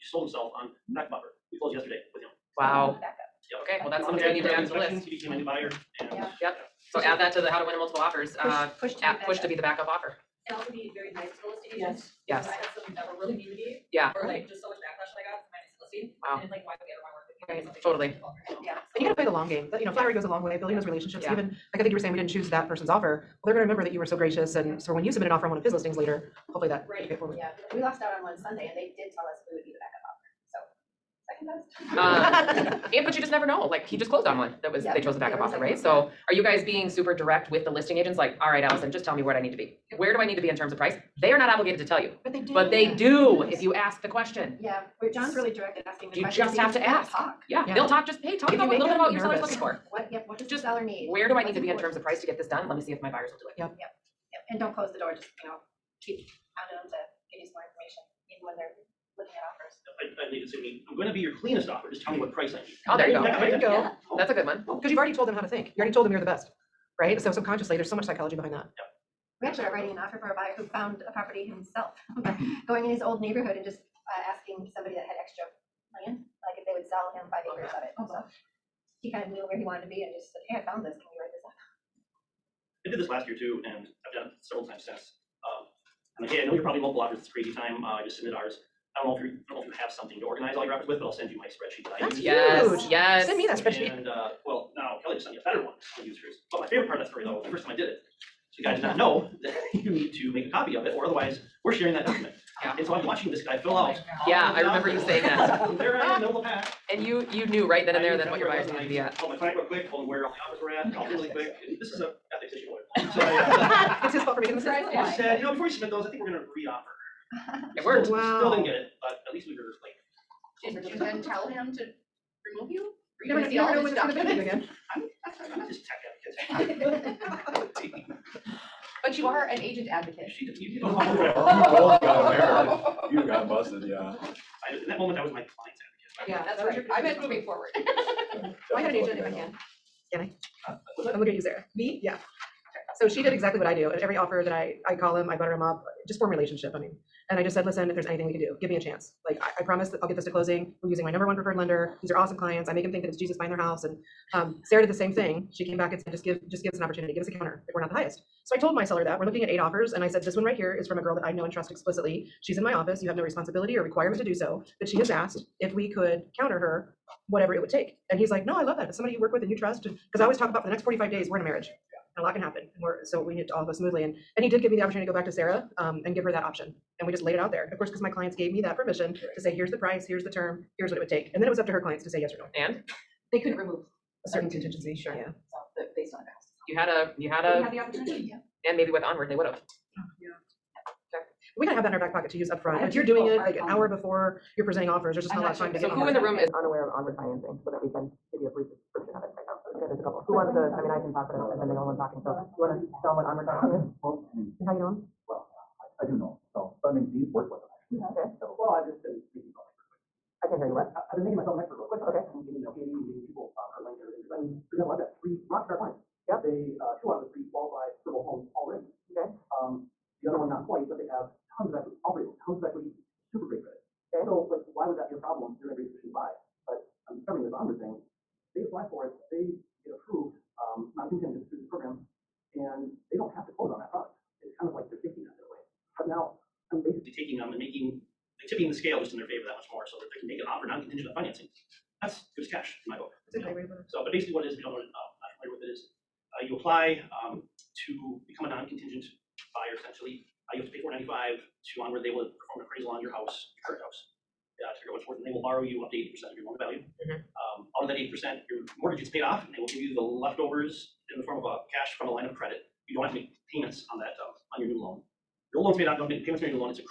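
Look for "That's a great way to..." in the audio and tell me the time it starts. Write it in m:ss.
4:03.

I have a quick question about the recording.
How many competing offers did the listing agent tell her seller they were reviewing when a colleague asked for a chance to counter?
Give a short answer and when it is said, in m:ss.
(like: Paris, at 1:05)
8, at 2:39.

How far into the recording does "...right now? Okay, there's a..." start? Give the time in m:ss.
3:19.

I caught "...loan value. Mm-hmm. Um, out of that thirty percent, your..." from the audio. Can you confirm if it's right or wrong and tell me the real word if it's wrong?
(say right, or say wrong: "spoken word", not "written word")
wrong: "eighty", not "thirty".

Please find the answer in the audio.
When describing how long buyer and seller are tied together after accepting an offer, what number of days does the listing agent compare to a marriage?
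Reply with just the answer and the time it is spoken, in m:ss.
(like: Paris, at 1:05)
45, at 2:50.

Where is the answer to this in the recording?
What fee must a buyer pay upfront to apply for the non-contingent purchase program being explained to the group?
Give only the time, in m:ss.
4:10.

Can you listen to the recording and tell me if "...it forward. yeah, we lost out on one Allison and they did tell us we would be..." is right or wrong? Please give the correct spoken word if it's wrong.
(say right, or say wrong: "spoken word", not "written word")
wrong: "Sunday", not "Allison".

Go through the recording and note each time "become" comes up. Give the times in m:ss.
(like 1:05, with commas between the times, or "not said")
4:08.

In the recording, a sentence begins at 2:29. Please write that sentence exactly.
Like, I, I promise that I'll get this to closing.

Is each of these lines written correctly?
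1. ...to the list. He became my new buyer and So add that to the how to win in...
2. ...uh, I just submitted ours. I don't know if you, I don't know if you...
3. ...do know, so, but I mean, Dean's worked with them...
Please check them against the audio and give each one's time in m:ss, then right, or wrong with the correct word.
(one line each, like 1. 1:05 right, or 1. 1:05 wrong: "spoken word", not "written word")
1. 0:04 right
2. 1:27 right
3. 3:26 right.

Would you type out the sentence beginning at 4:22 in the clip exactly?
You don't have to make payments on that, uh, on your new loan.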